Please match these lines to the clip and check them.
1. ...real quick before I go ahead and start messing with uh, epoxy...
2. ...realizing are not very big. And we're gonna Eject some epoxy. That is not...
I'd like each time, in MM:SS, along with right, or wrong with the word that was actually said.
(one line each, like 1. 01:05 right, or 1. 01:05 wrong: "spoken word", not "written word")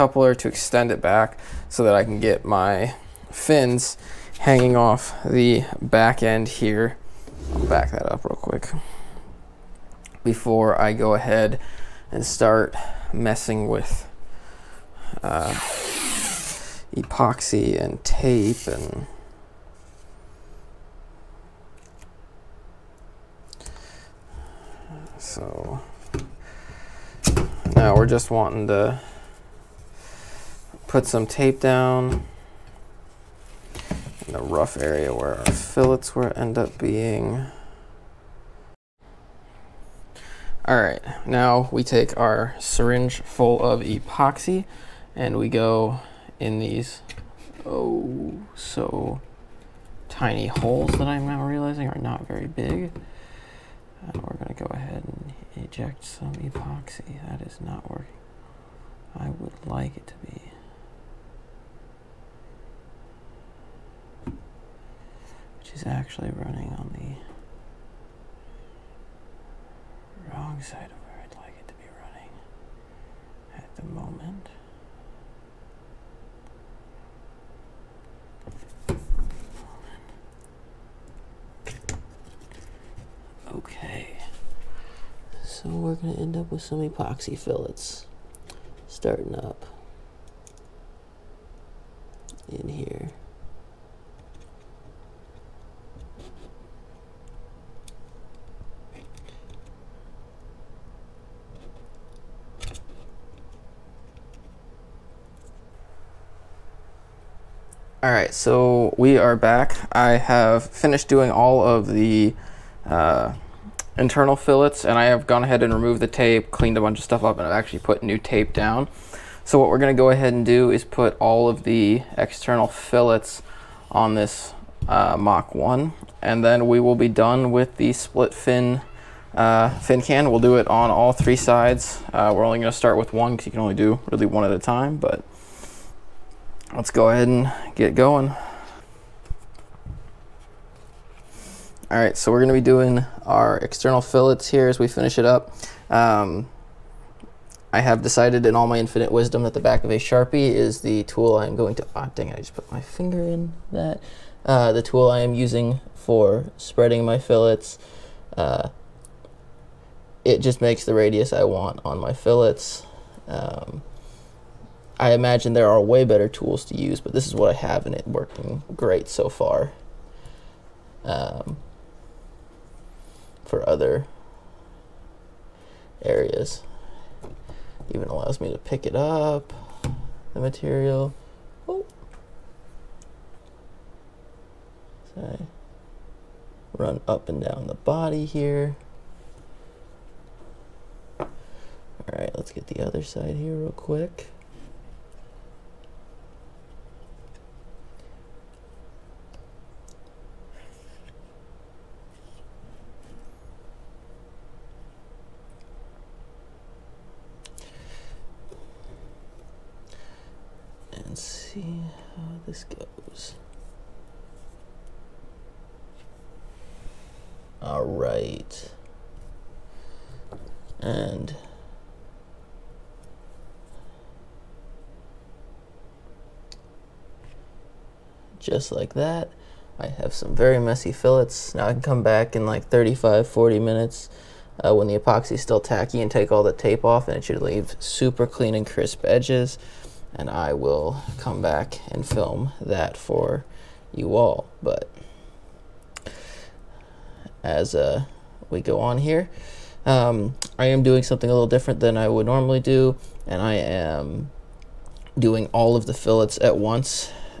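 1. 00:08 right
2. 00:51 right.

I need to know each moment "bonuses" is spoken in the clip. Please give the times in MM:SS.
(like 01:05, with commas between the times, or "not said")
not said.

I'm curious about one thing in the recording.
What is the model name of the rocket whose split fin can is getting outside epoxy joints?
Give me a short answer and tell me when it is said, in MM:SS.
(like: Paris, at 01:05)
Mach 1, at 02:05.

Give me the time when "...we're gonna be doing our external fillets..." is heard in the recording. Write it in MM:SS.
02:22.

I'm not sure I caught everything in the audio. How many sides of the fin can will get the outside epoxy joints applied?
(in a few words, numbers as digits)
3.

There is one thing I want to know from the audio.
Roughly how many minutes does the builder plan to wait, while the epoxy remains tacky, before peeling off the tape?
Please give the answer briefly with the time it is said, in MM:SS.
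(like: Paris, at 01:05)
35 to 40 minutes, at 03:52.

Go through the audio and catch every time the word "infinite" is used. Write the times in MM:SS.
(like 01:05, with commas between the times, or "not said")
02:28.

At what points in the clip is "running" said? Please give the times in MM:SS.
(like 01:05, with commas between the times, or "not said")
01:06, 01:11.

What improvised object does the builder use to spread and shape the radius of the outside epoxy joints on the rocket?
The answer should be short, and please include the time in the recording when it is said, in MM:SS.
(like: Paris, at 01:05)
Back of a Sharpie, at 02:29.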